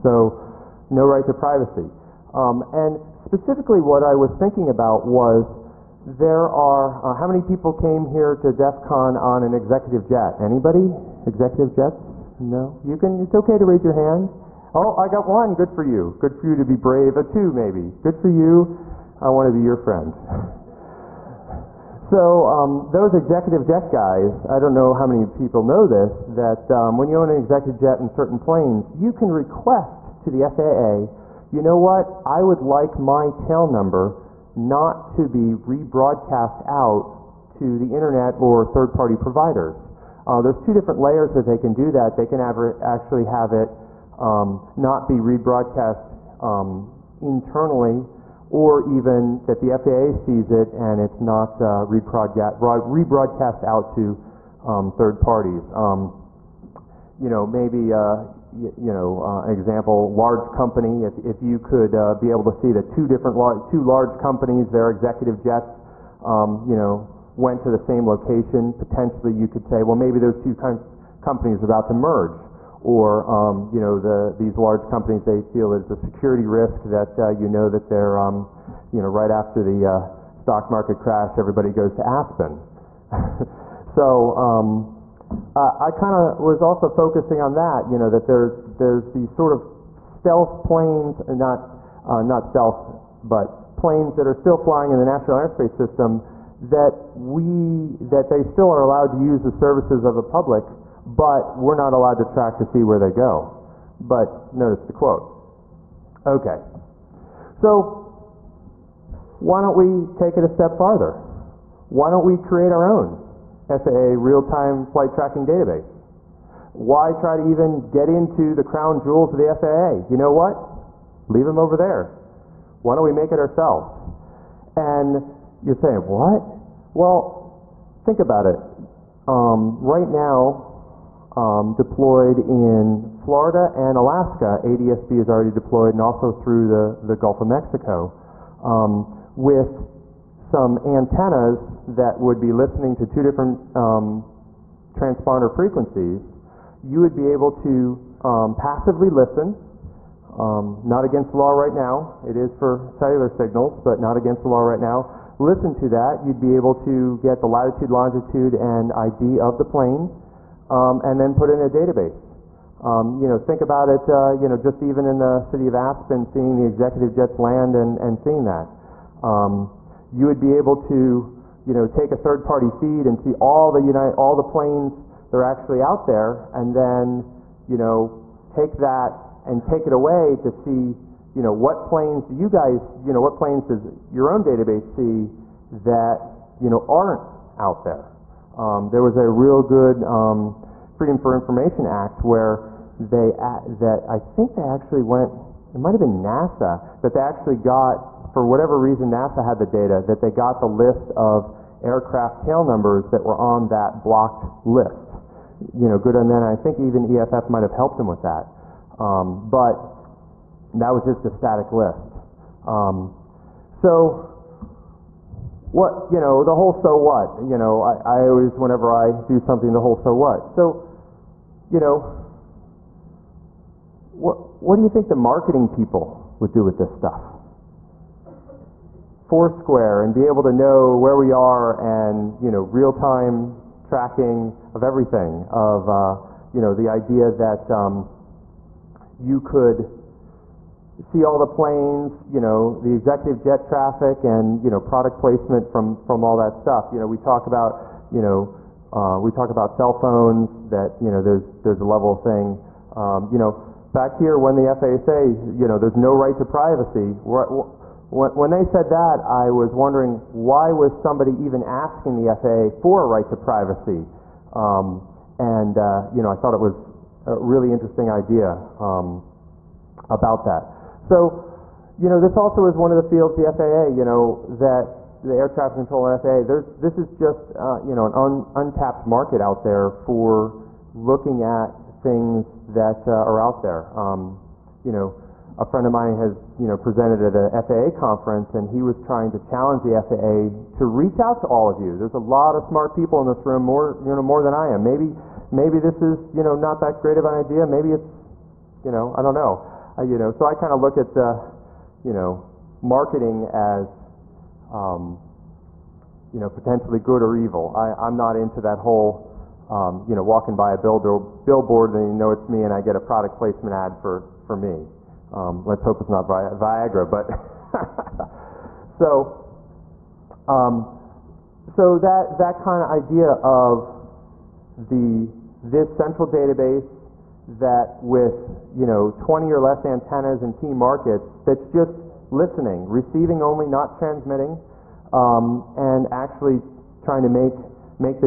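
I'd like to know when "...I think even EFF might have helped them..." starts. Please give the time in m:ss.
3:26.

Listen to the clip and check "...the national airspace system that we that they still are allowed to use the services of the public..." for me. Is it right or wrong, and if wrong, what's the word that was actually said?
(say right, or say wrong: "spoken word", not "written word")
right.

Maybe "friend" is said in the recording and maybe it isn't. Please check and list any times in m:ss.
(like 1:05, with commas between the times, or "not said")
0:19, 4:45.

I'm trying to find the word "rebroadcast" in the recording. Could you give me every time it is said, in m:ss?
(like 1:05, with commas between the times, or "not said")
0:35, 0:45, 0:51.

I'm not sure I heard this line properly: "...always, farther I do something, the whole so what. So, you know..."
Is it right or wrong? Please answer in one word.
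wrong.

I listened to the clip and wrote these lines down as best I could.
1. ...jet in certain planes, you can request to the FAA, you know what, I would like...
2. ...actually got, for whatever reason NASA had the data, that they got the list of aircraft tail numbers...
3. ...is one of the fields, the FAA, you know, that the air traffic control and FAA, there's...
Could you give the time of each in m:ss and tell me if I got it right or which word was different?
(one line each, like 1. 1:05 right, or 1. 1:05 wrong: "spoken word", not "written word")
1. 0:27 right
2. 3:17 right
3. 4:32 right.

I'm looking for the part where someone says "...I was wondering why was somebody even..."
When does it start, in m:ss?
4:19.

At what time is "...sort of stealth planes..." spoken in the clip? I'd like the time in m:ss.
1:29.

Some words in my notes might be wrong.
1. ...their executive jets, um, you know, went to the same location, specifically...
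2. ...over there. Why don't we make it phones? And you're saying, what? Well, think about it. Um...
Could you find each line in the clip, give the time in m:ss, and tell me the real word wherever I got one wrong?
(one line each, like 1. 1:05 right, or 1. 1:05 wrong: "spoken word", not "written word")
1. 1:04 wrong: "potentially", not "specifically"
2. 2:01 wrong: "ourselves", not "phones".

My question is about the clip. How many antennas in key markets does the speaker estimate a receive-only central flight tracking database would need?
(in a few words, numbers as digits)
20 or less.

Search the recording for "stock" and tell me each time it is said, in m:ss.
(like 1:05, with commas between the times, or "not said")
1:20.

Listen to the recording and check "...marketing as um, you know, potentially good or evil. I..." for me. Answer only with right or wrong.
right.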